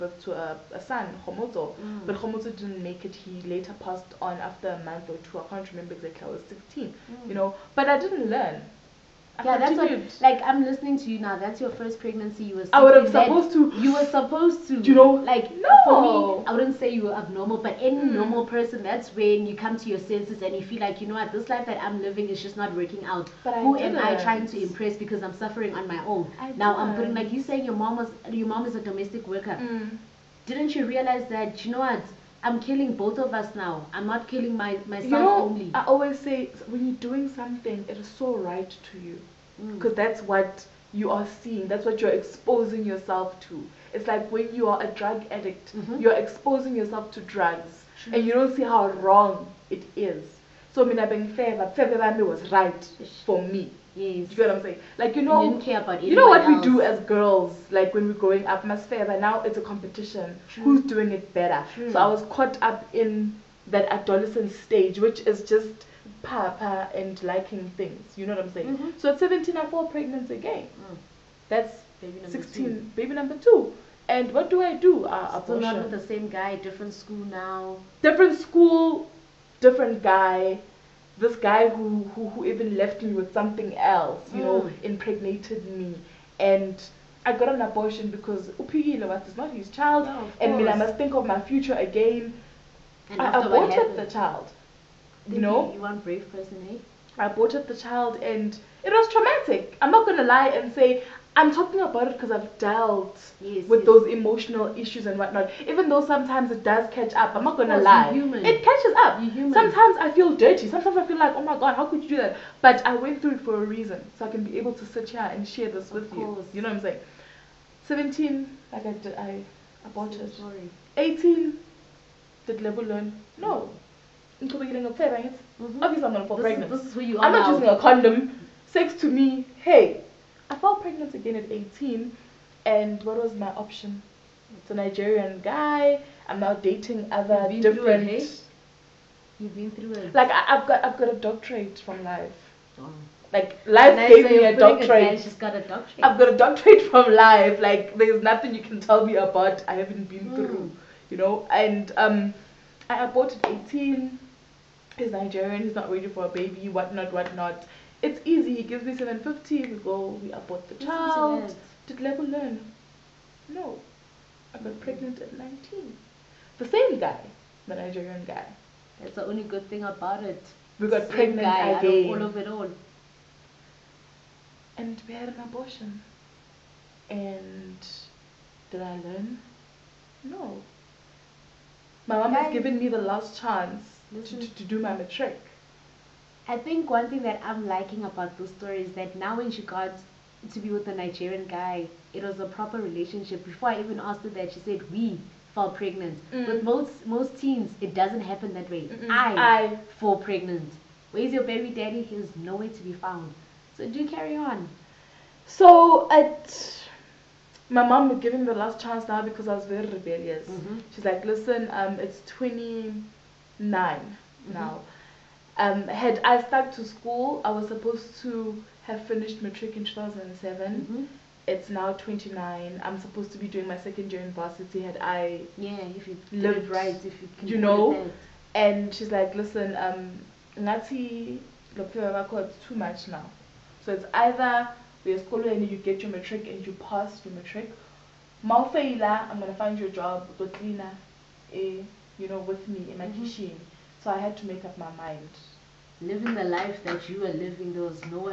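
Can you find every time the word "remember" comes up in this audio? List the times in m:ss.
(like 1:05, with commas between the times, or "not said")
0:05.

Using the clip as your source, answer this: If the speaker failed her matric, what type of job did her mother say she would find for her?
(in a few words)
cleaner.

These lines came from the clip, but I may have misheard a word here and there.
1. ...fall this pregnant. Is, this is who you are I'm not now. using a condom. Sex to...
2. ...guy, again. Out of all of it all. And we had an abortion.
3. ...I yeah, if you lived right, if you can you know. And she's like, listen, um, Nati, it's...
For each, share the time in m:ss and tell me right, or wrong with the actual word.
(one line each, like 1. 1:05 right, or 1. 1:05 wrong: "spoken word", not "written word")
1. 2:06 right
2. 2:51 right
3. 3:44 right.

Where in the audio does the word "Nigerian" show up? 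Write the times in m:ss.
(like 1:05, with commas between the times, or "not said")
2:14, 2:35, 2:47, 3:10.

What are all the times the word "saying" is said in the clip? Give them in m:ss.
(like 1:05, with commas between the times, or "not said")
0:27, 0:54, 1:08, 1:56.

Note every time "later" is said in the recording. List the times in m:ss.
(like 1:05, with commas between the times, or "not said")
0:03.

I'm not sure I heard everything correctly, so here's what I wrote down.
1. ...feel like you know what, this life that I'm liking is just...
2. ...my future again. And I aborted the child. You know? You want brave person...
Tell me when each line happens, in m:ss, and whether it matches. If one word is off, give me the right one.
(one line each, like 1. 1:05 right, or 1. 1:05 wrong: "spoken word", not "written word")
1. 0:20 wrong: "living", not "liking"
2. 1:31 right.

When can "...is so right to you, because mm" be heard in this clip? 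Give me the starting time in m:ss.
0:37.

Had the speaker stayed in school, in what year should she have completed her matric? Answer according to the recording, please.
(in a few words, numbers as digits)
2007.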